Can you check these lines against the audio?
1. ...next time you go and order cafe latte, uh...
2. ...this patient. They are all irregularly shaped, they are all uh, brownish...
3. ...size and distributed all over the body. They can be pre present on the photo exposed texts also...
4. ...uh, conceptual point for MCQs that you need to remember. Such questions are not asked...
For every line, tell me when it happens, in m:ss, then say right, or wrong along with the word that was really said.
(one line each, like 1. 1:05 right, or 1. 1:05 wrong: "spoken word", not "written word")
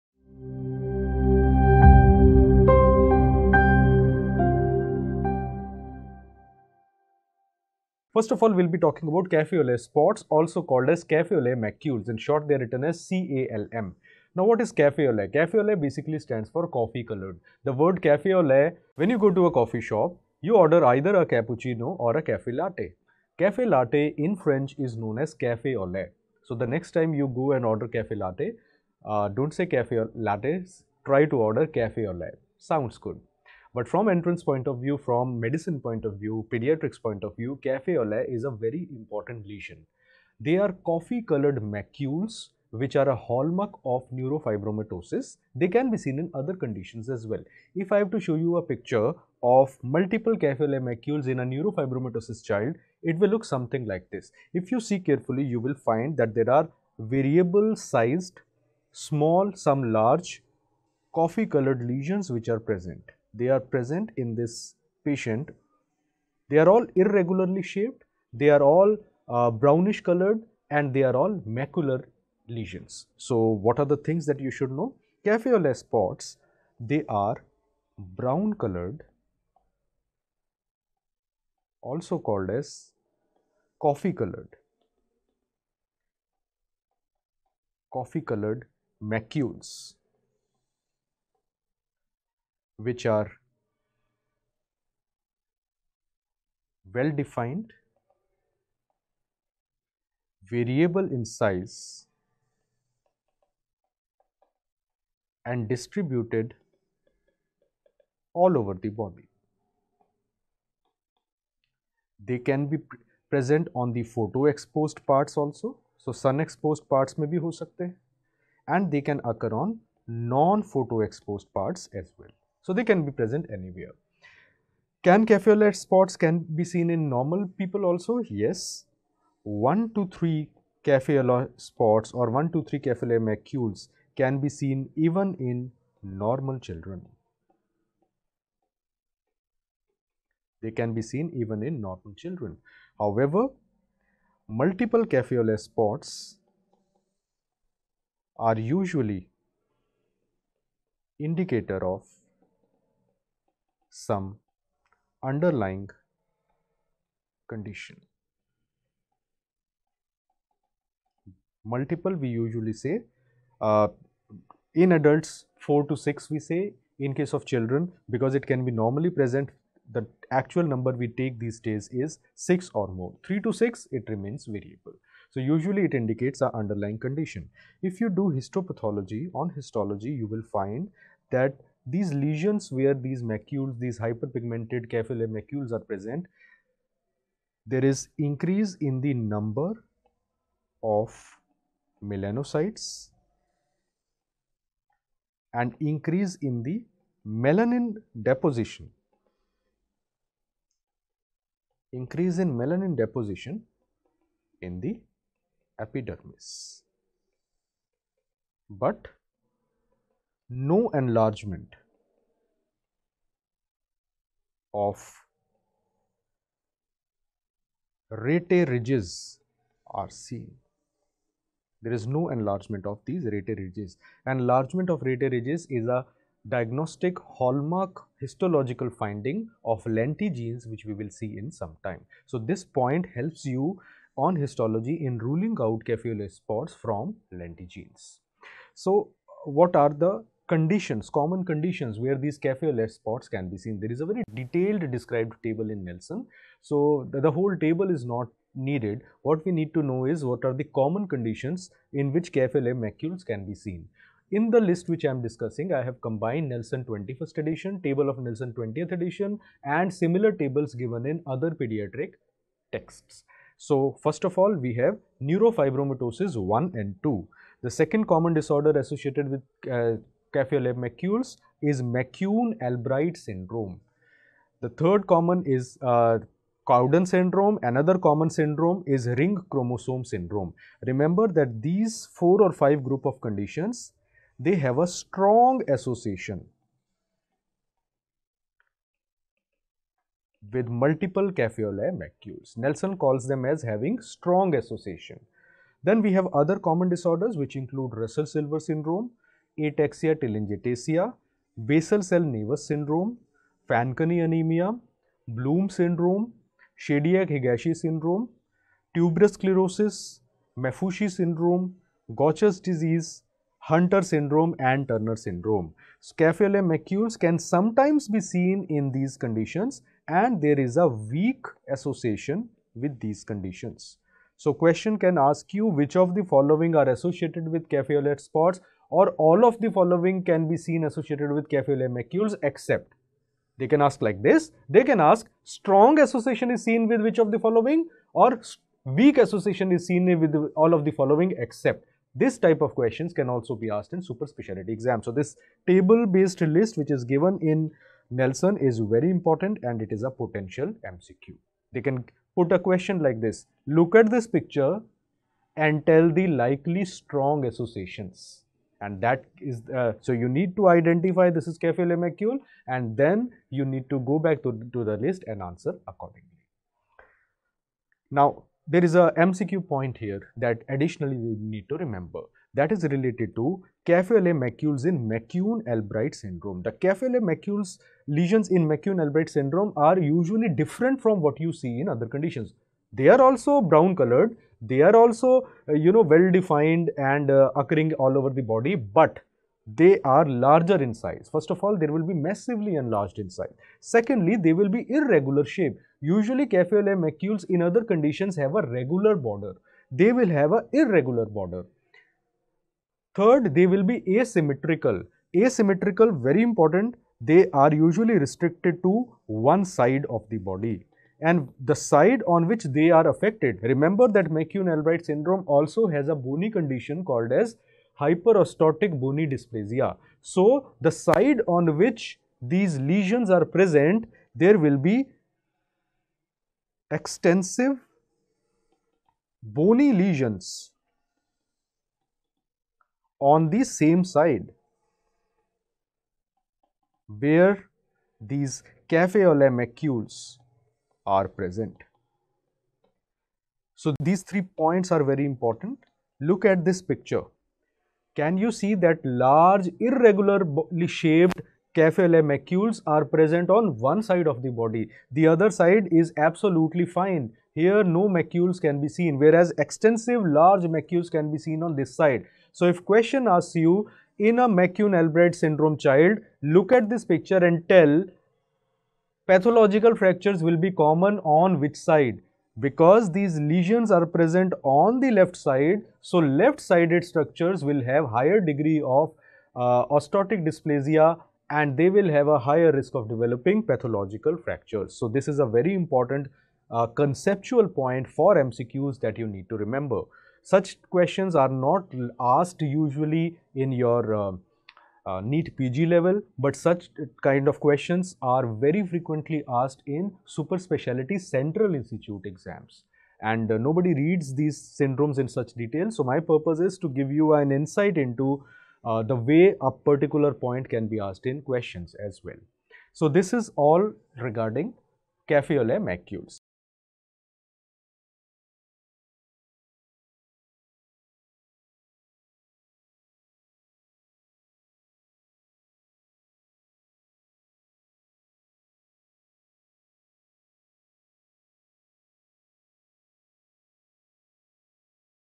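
1. 0:26 right
2. 1:04 right
3. 1:41 wrong: "parts", not "texts"
4. 8:06 right.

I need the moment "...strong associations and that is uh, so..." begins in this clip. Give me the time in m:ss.
5:56.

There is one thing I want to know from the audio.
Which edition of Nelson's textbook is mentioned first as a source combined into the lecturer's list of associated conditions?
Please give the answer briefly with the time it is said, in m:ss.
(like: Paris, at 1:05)
21st edition, at 4:16.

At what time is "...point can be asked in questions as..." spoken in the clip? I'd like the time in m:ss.
8:30.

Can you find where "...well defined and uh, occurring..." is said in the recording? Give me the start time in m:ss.
6:26.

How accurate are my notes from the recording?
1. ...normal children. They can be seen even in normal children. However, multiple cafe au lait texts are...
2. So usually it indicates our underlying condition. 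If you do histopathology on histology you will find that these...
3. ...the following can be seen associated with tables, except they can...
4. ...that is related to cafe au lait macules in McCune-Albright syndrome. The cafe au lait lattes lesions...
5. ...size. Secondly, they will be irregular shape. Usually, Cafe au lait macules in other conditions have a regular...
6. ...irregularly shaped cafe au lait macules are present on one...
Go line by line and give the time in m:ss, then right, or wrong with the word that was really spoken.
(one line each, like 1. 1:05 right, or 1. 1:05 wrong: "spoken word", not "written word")
1. 2:16 wrong: "spots", not "texts"
2. 2:55 right
3. 5:29 wrong: "macules", not "tables"
4. 6:12 wrong: "macules", not "lattes"
5. 6:33 right
6. 7:29 right.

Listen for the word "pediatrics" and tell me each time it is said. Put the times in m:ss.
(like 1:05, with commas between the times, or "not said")
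0:36, 4:21.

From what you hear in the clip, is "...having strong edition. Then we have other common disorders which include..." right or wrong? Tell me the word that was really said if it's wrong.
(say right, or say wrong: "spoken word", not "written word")
wrong: "association", not "edition".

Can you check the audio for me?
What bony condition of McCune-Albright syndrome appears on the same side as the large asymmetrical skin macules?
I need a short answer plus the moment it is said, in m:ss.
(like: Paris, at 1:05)
hyperostotic bony dysplasia, at 6:57.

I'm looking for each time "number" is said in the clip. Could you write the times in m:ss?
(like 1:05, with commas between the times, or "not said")
2:50, 3:09.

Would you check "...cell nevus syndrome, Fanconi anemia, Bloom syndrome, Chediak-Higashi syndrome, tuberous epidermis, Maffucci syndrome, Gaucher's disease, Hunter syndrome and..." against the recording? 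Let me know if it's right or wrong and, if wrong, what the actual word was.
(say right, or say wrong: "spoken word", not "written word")
wrong: "sclerosis", not "epidermis".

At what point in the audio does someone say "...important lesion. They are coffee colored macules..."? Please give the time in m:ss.
0:38.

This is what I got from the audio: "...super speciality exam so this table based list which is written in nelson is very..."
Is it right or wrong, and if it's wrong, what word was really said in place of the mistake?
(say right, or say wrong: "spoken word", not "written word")
wrong: "given", not "written".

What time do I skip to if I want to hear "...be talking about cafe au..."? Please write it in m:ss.
0:08.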